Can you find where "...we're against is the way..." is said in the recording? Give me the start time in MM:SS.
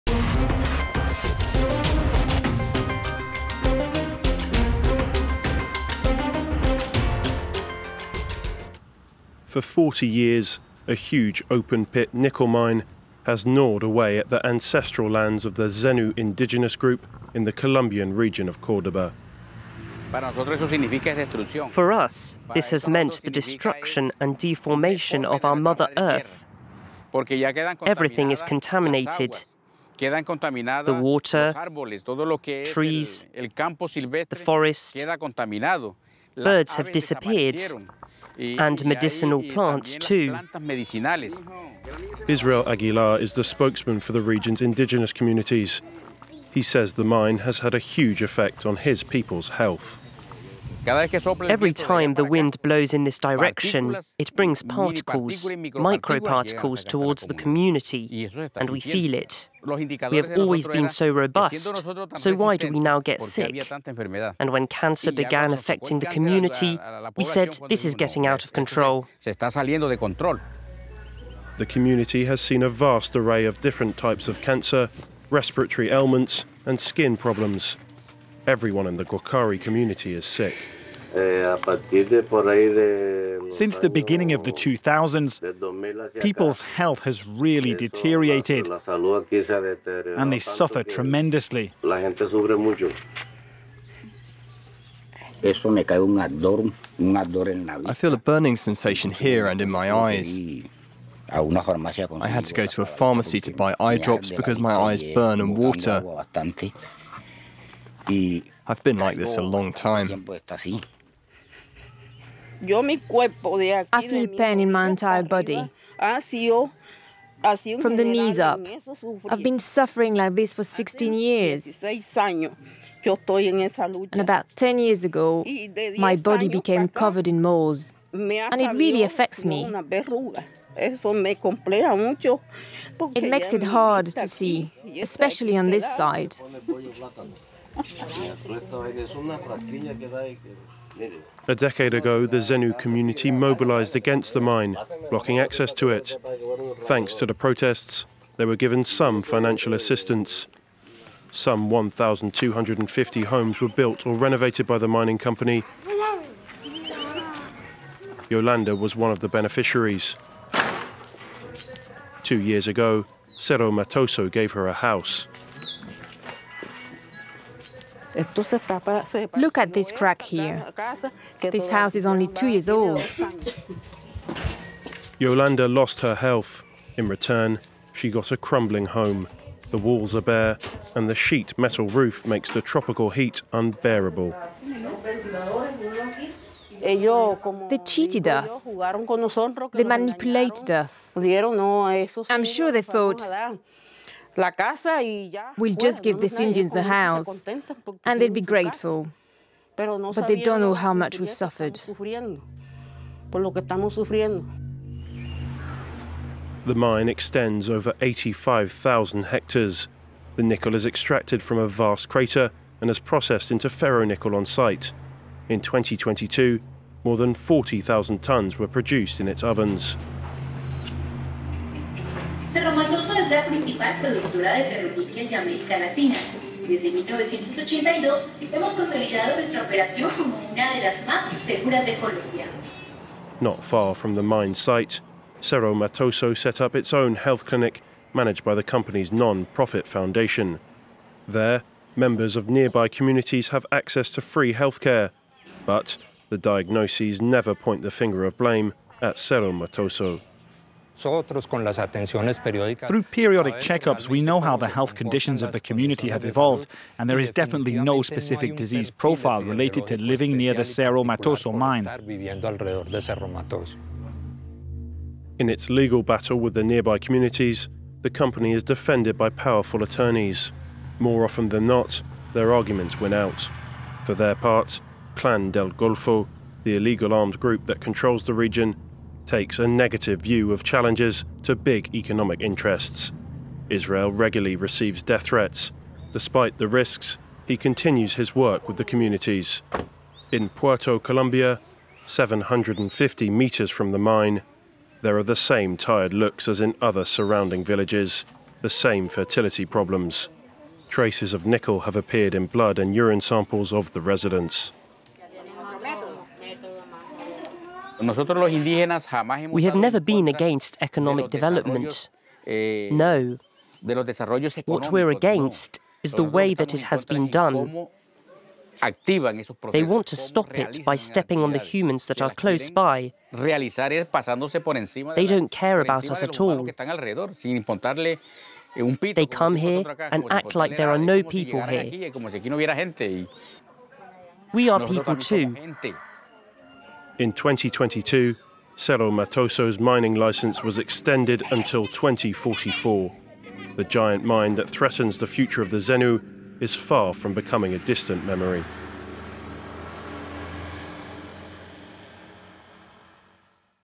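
05:14.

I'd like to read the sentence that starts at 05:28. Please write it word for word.
Eh, they come here and act like there are no people here.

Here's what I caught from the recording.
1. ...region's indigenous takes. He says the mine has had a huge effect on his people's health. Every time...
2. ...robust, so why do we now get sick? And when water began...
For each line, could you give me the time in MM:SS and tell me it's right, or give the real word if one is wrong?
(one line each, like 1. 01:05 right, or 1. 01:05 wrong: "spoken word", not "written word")
1. 00:44 wrong: "communities", not "takes"
2. 01:01 wrong: "cancer", not "water".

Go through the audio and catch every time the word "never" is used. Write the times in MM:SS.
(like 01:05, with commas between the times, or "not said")
04:07, 05:09.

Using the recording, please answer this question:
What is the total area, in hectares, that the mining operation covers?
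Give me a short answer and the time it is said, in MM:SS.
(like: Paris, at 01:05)
85,000 hectares, at 03:28.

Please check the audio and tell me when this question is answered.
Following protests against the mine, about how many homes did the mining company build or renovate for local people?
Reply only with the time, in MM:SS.
02:31.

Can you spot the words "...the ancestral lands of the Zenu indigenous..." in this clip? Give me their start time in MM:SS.
00:14.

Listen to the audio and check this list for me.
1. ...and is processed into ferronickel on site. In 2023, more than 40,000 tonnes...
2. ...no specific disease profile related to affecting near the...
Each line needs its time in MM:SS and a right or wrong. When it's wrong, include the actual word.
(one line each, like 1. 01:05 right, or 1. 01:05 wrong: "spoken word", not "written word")
1. 03:32 wrong: "2022", not "2023"
2. 04:17 wrong: "living", not "affecting".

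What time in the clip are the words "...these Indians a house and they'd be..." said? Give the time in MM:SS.
03:16.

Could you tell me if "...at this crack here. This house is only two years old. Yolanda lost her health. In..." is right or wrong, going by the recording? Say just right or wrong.
right.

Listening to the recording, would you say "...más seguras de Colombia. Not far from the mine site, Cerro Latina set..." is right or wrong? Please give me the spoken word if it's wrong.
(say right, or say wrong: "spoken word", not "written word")
wrong: "Matoso", not "Latina".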